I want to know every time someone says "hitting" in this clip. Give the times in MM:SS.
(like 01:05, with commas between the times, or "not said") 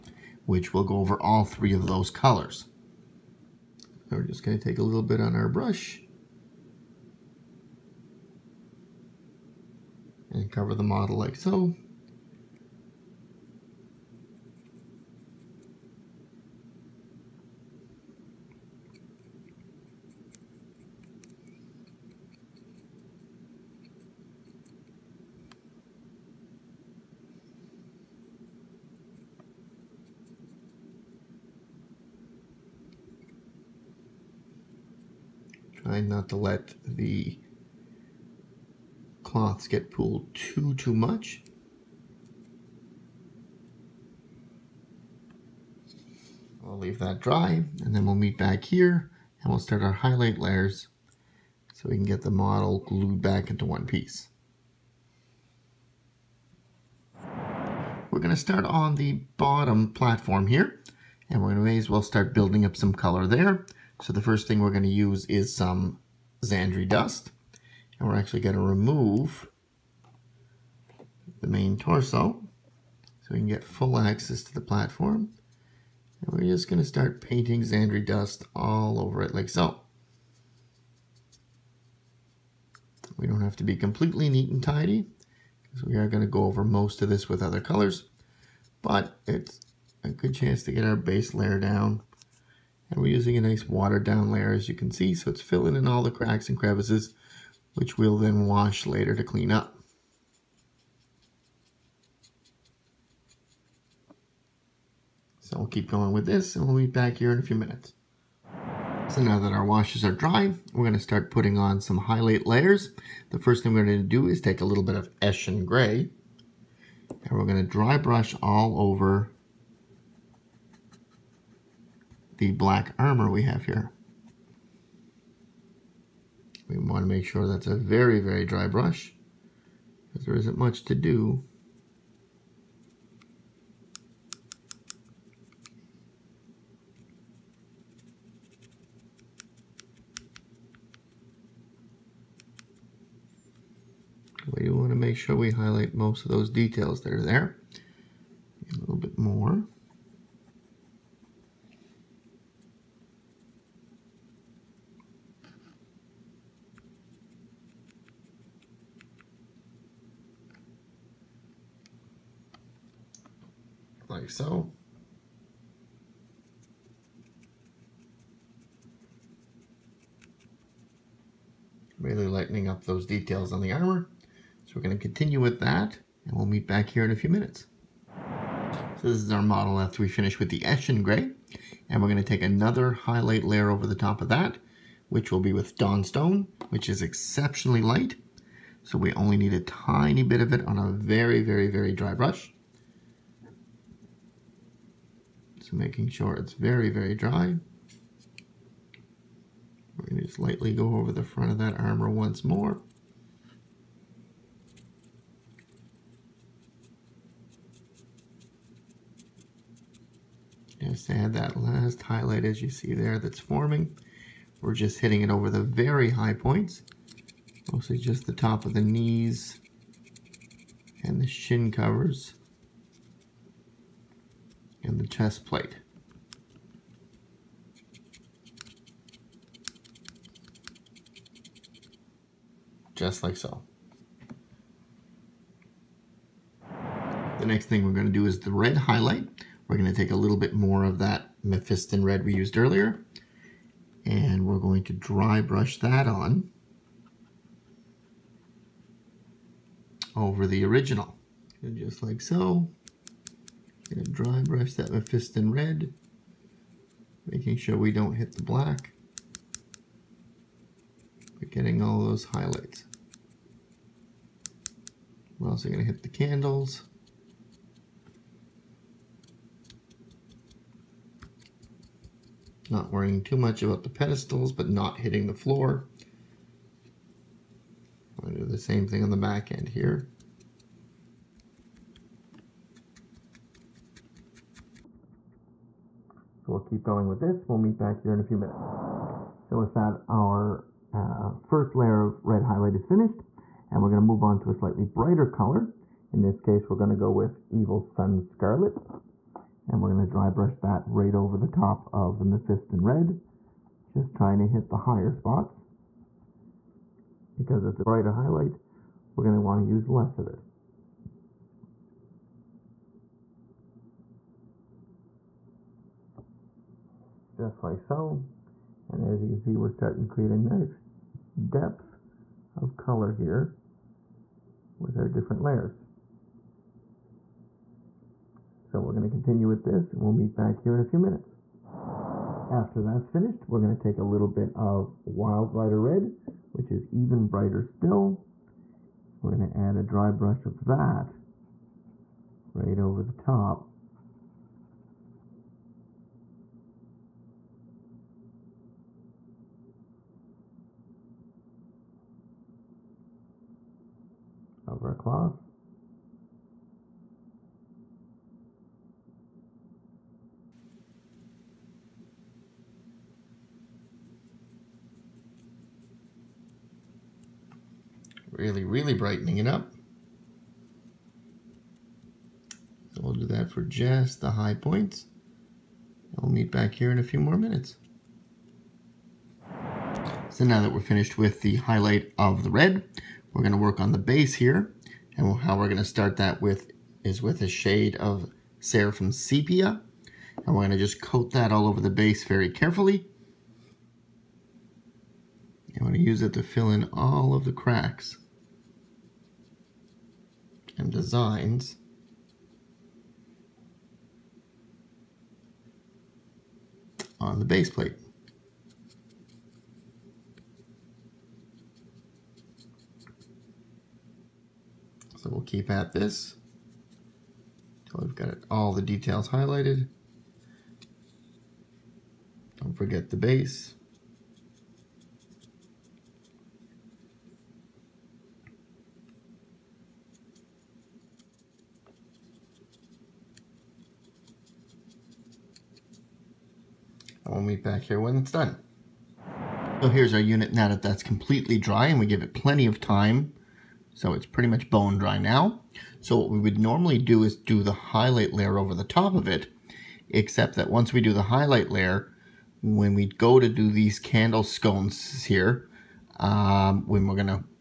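03:35, 04:34.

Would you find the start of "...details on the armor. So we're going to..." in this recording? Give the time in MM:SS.
02:53.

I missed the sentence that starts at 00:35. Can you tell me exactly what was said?
Try not to let the cloths get pulled too, too much.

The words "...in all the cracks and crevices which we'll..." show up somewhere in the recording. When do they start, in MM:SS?
01:35.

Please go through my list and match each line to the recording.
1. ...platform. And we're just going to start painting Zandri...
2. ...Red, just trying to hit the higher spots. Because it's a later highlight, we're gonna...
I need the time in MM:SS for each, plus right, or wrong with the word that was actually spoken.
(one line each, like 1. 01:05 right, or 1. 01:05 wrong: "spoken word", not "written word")
1. 01:14 right
2. 05:02 wrong: "brighter", not "later".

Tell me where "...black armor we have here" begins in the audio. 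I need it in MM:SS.
02:02.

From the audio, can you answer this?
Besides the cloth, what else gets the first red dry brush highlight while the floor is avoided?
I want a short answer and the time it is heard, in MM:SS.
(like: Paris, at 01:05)
The candles, at 04:26.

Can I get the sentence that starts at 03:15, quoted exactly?
making sure it's very, very dry.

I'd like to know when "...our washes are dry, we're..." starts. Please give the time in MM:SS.
01:49.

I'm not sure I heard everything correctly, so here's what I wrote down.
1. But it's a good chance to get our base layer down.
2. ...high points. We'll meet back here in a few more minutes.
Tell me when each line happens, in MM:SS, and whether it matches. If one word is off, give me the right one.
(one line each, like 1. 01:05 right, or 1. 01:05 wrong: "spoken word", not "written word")
1. 01:28 right
2. 06:14 right.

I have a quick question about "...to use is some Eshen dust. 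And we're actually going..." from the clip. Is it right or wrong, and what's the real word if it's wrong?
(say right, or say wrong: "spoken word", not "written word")
wrong: "Zandri", not "Eshen".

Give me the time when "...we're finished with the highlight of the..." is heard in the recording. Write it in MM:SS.
06:20.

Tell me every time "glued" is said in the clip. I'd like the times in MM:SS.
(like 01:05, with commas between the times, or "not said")
00:52.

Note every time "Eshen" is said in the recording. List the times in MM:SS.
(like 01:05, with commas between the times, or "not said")
01:55, 03:00.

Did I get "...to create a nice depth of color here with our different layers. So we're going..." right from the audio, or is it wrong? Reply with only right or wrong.
right.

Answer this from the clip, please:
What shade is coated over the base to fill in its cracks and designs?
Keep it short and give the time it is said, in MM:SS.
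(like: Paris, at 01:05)
Seraphim Sepia, at 06:28.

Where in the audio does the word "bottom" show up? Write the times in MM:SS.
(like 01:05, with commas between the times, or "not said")
00:59.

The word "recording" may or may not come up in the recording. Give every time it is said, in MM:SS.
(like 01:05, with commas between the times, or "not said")
not said.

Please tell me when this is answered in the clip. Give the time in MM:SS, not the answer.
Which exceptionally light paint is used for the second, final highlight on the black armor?
03:05.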